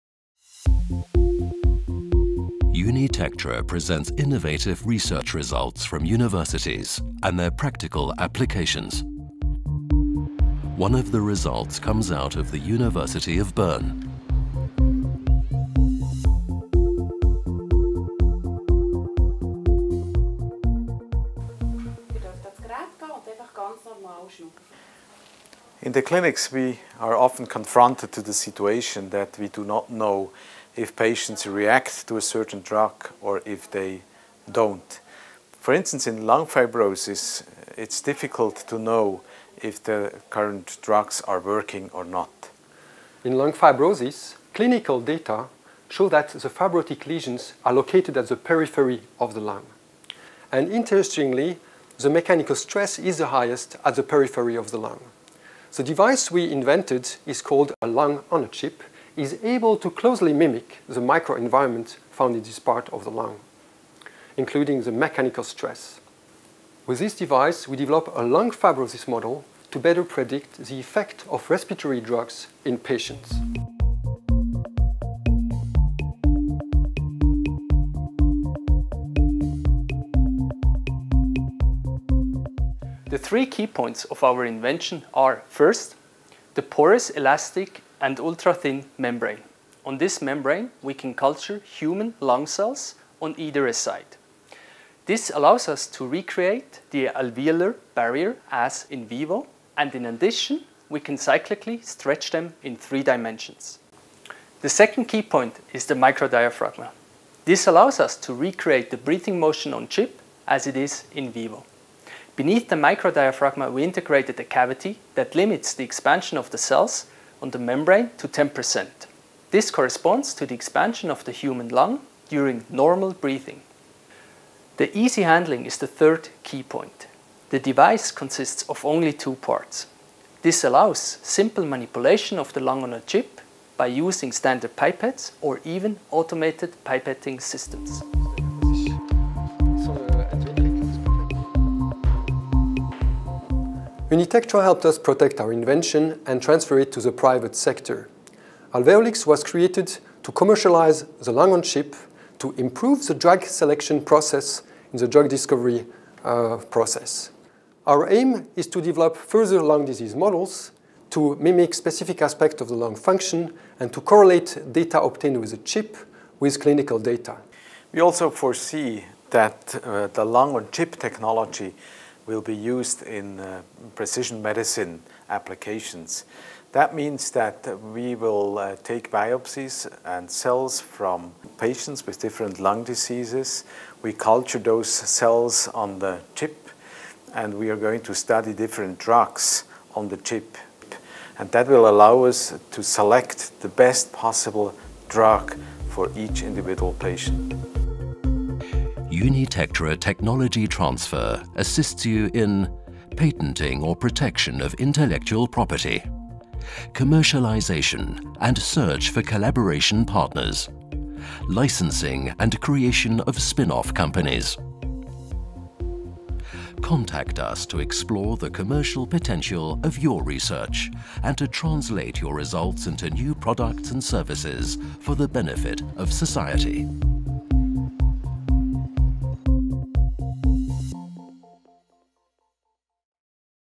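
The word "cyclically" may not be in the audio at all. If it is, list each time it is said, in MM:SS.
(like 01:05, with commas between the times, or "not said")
01:41.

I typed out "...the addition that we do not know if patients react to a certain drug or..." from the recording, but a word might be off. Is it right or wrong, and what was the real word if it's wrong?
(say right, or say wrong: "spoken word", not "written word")
wrong: "situation", not "addition".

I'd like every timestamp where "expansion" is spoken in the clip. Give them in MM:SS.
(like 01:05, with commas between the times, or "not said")
01:55, 02:00.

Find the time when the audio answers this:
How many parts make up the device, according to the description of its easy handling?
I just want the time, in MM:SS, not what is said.
02:09.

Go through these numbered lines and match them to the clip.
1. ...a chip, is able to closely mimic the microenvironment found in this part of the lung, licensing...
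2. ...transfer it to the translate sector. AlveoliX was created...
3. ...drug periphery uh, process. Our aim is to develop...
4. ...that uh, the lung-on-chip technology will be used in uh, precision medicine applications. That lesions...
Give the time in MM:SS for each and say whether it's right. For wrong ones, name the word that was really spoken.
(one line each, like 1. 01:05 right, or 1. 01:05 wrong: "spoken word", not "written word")
1. 00:58 wrong: "including", not "licensing"
2. 02:26 wrong: "private", not "translate"
3. 02:35 wrong: "discovery", not "periphery"
4. 02:49 wrong: "means", not "lesions".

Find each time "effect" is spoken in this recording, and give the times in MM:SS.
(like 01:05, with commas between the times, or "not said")
01:10.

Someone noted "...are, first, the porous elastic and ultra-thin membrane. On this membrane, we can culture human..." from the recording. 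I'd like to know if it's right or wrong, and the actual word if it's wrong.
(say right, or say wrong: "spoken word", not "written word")
right.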